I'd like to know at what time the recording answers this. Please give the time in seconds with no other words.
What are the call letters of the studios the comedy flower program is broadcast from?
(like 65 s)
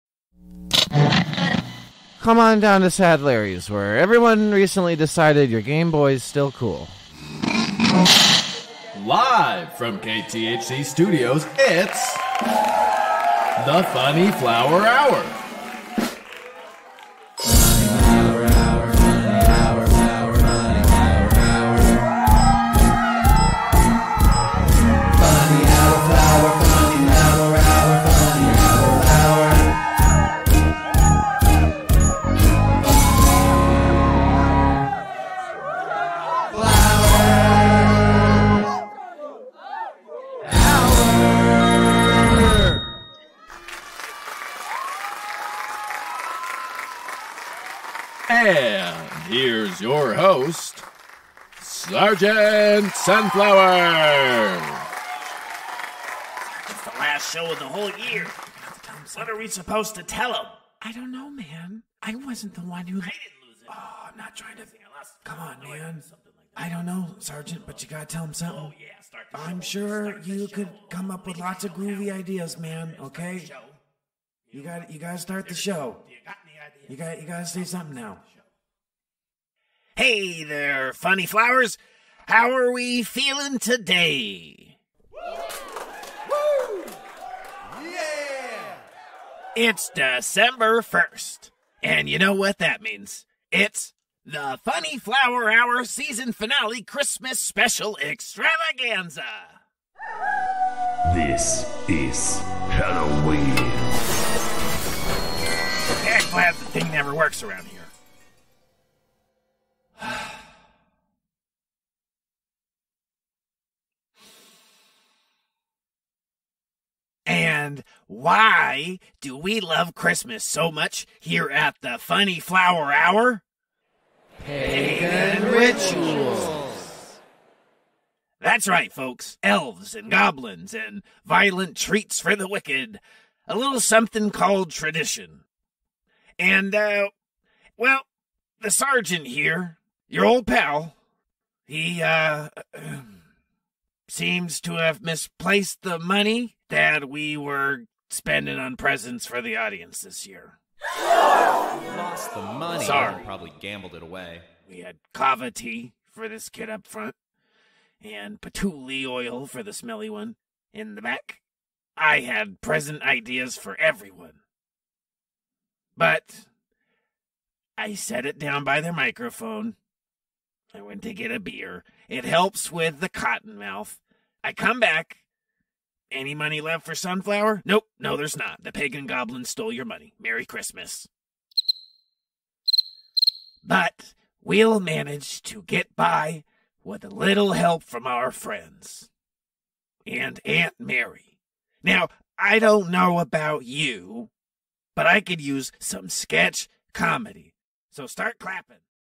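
9 s.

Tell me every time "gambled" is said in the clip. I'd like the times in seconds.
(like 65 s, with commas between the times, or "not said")
153 s.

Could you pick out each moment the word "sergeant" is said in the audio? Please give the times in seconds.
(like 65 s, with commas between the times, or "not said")
51 s, 67 s, 138 s.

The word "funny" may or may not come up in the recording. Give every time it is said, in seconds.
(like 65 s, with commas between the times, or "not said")
13 s, 80 s, 94 s, 121 s.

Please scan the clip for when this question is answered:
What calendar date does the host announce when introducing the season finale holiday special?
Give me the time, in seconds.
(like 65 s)
89 s.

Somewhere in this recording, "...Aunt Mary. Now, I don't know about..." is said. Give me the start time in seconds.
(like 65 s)
190 s.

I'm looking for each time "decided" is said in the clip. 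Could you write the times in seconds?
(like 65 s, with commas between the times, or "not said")
4 s.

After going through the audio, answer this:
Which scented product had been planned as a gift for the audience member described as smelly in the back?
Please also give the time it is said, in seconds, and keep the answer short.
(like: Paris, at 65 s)
Patchouli oil, at 158 s.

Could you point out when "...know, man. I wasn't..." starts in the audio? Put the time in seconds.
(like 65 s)
61 s.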